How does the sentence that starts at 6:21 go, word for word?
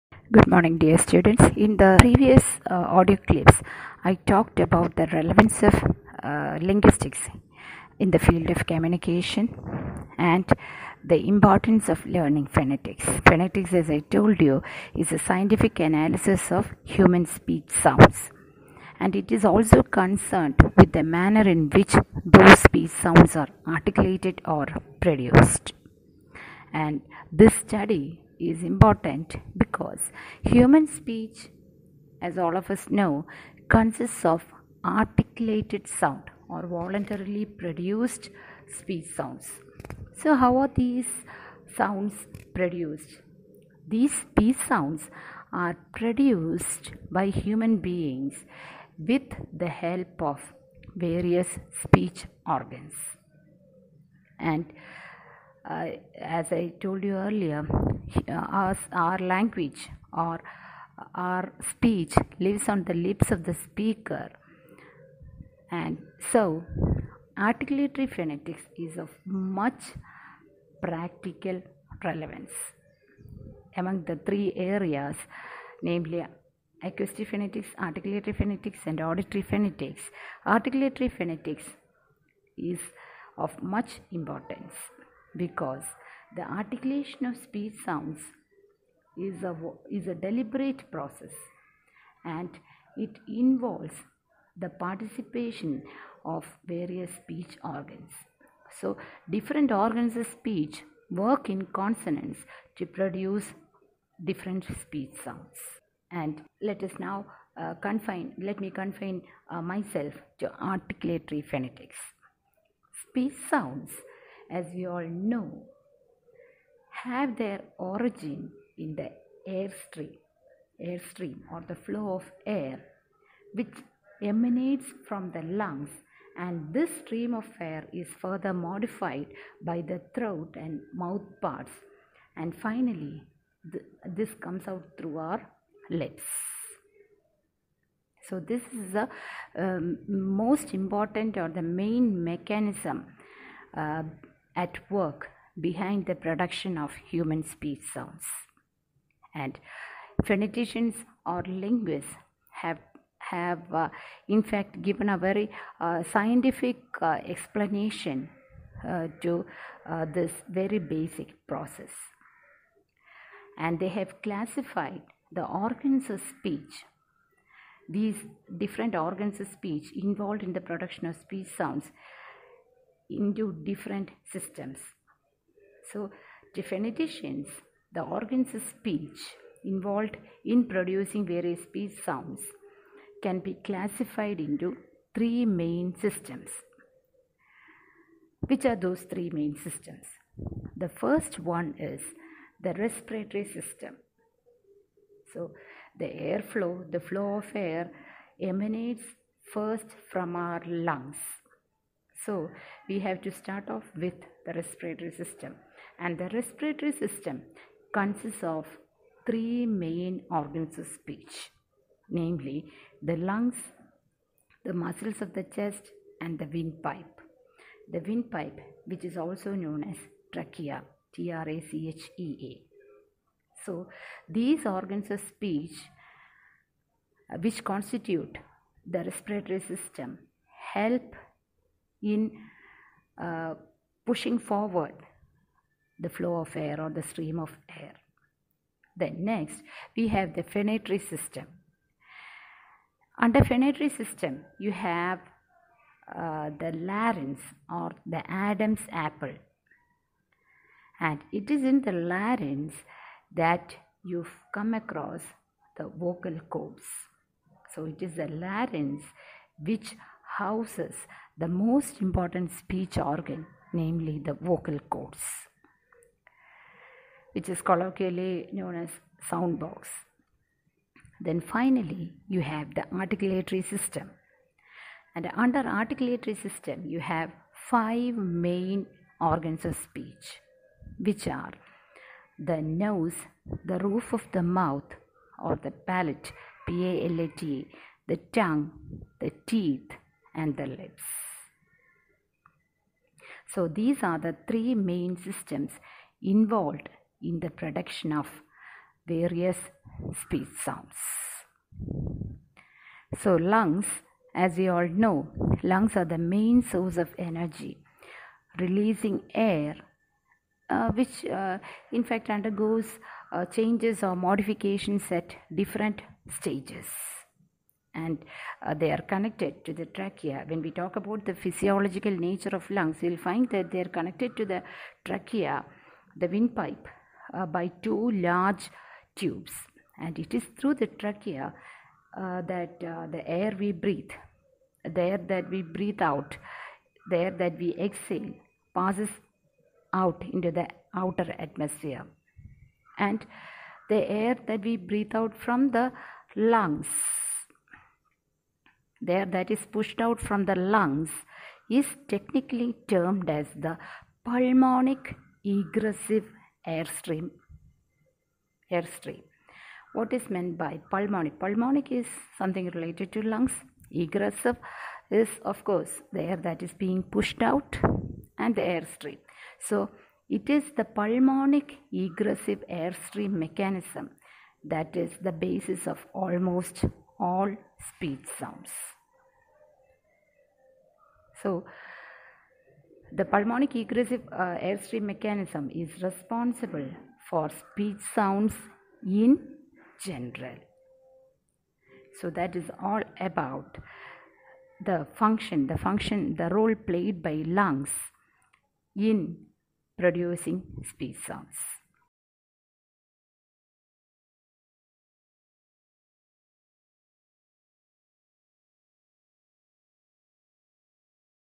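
So, the pulmonic egressive uh, airstream mechanism is responsible for speech sounds in general.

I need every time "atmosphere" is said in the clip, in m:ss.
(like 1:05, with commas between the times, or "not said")
5:41.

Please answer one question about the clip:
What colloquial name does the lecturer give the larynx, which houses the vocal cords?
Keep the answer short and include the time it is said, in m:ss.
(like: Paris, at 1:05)
sound box, at 4:29.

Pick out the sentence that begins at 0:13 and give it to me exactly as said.
Phonetics, as I told you, is a scientific analysis of human speech sounds.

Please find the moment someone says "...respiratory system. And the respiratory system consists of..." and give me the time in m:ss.
3:24.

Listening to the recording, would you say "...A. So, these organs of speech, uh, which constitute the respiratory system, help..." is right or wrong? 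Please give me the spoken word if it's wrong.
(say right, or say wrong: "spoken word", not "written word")
right.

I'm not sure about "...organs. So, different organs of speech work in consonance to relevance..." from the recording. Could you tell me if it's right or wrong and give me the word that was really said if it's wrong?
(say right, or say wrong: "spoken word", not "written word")
wrong: "produce", not "relevance".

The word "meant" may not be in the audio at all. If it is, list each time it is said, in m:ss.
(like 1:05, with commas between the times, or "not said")
6:00.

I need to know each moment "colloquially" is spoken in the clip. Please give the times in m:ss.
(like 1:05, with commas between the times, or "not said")
4:27.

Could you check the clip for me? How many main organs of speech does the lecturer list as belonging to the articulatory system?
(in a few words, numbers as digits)
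5.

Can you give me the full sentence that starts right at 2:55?
So, definitions: the organs of speech involved in producing various speech sounds, can be classified into three main systems.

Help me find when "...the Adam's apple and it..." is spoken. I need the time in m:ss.
4:08.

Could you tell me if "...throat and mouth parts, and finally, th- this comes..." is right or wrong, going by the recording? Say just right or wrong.
right.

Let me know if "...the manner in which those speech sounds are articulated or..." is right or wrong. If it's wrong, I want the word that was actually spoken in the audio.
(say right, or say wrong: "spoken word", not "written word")
right.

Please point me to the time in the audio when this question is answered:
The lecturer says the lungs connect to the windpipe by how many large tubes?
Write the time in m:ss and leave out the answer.
5:27.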